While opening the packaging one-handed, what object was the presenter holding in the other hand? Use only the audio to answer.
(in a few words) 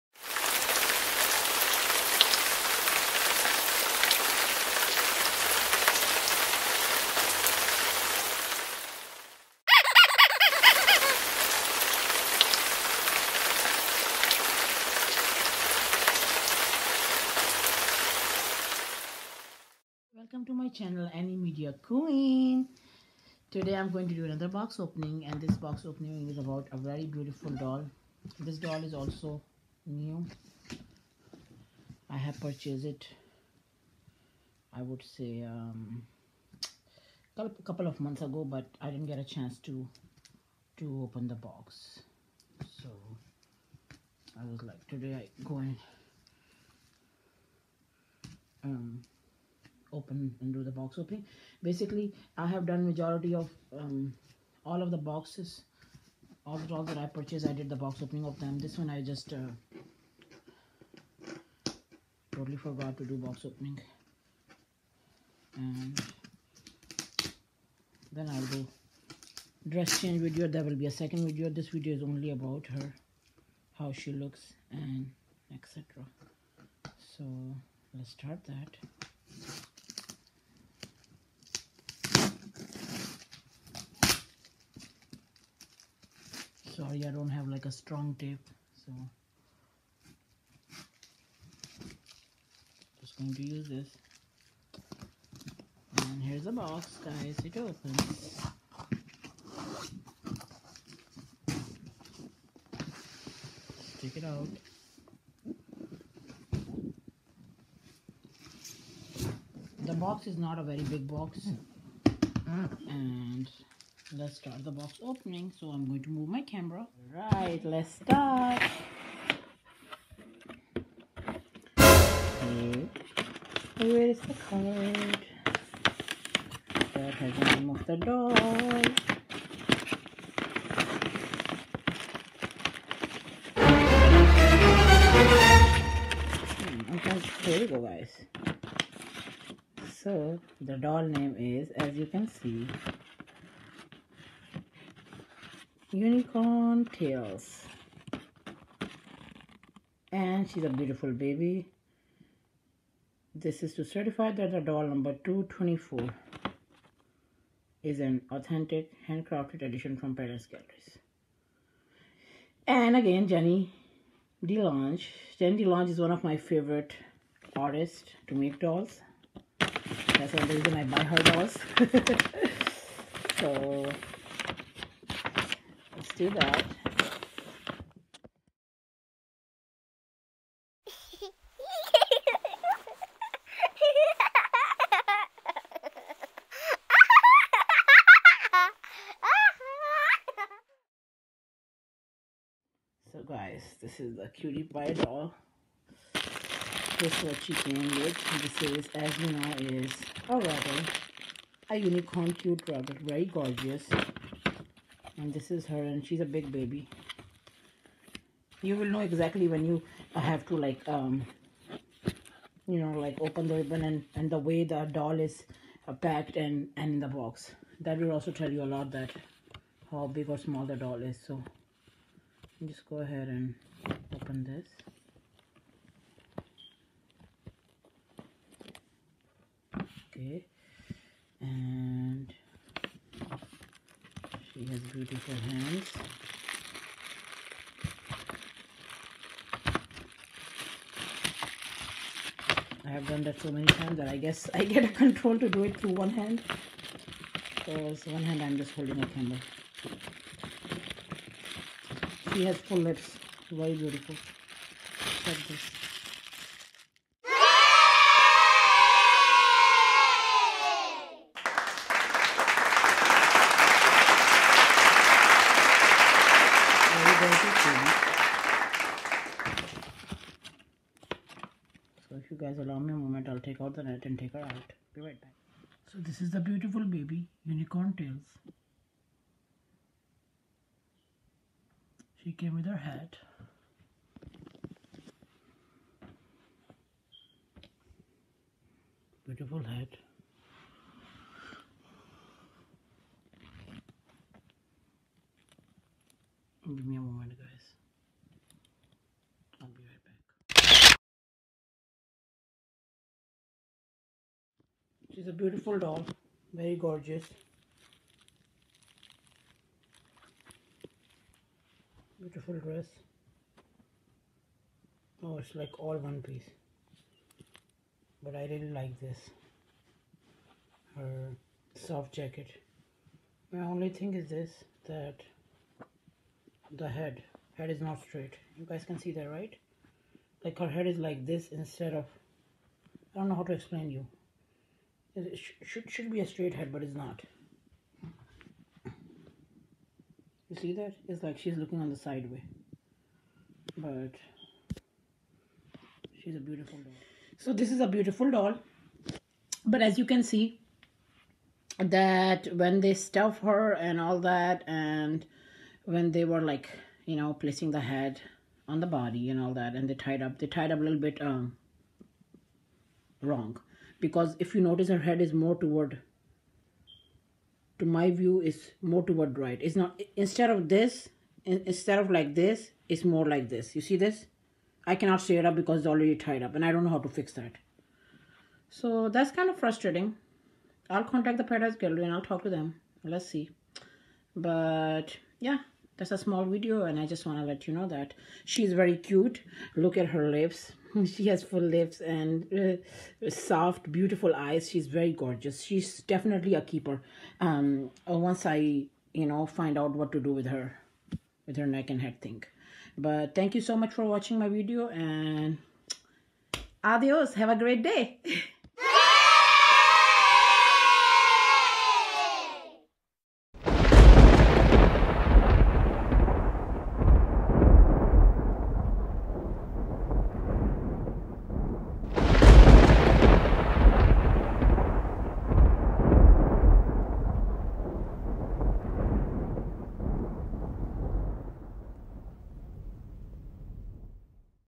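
A candle.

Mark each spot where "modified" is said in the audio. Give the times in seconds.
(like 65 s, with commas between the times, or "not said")
not said.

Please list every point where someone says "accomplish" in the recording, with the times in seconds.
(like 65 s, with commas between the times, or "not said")
not said.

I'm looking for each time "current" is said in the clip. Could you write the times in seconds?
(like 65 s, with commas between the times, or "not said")
not said.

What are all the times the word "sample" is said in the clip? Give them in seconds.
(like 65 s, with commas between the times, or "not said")
not said.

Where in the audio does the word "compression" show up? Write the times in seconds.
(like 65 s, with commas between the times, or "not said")
not said.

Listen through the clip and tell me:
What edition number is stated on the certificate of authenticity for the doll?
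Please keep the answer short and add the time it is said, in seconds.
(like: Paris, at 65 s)
224, at 155 s.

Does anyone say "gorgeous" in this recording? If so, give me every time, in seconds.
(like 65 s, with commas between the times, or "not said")
203 s, 306 s, 395 s.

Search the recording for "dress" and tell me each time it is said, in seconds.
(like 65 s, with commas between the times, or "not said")
69 s, 312 s.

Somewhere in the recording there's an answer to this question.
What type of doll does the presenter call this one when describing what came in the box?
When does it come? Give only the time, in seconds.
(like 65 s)
194 s.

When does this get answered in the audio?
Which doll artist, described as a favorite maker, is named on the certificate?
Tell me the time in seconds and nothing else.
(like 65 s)
165 s.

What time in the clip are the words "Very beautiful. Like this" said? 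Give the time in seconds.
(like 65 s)
253 s.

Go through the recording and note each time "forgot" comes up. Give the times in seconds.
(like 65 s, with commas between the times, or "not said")
62 s.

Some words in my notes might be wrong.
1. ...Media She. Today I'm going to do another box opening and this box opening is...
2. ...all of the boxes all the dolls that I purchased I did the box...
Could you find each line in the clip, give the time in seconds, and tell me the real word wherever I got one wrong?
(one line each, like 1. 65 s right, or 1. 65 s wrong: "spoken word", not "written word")
1. 21 s wrong: "Queen", not "She"
2. 54 s right.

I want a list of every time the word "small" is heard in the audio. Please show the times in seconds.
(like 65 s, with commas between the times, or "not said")
220 s, 386 s.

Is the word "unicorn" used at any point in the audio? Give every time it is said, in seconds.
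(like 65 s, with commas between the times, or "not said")
145 s, 201 s, 277 s.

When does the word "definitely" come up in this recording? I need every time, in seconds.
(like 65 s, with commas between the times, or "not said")
396 s.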